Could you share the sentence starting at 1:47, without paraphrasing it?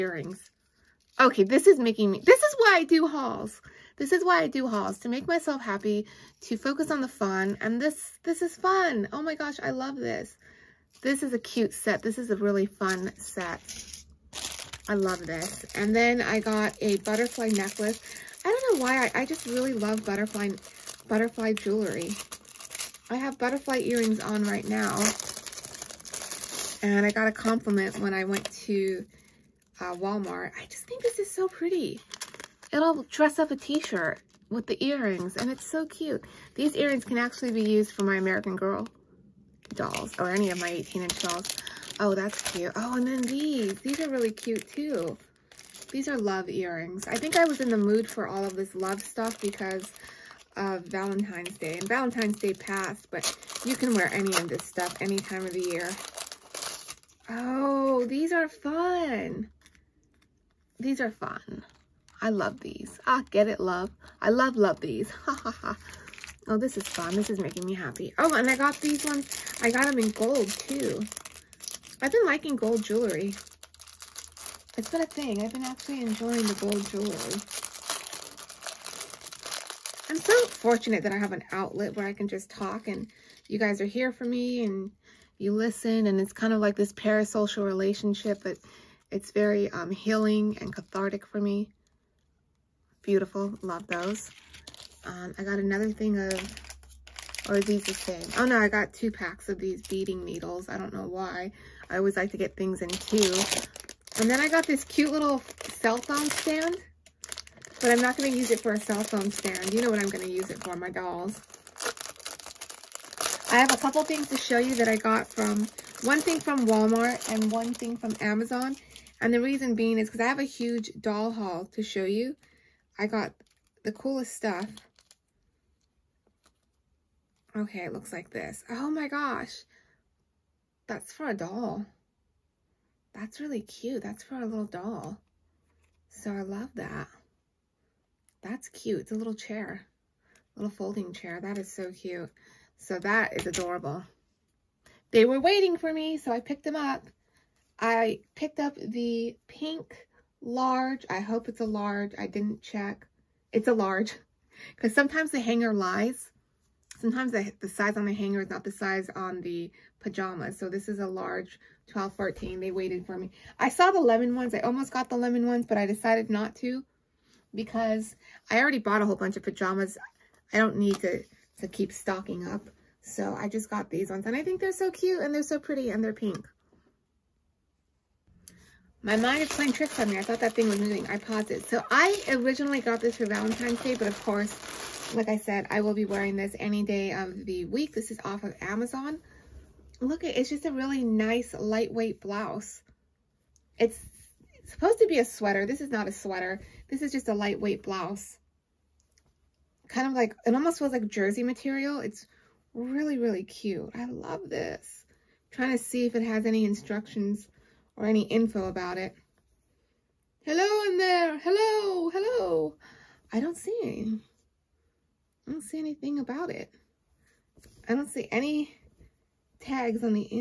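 But I'm not going to use it for a cell phone stand.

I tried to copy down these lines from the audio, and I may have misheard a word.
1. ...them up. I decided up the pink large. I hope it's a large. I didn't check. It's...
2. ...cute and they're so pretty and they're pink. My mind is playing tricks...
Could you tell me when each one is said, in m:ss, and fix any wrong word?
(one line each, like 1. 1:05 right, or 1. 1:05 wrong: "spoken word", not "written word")
1. 2:26 wrong: "picked", not "decided"
2. 2:54 right.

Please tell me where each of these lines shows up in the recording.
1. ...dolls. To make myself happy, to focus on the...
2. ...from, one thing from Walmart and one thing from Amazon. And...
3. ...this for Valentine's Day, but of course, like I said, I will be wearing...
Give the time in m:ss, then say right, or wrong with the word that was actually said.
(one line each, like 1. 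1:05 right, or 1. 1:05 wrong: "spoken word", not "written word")
1. 0:04 wrong: "hauls", not "dolls"
2. 1:55 right
3. 3:03 right.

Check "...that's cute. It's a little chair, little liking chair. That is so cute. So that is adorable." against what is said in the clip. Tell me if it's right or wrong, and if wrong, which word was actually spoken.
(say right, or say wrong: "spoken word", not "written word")
wrong: "folding", not "liking".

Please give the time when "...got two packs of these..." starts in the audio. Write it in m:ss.
1:38.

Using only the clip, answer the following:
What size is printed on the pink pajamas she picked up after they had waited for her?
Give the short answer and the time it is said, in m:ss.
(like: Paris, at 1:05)
Large 12, 14, at 2:41.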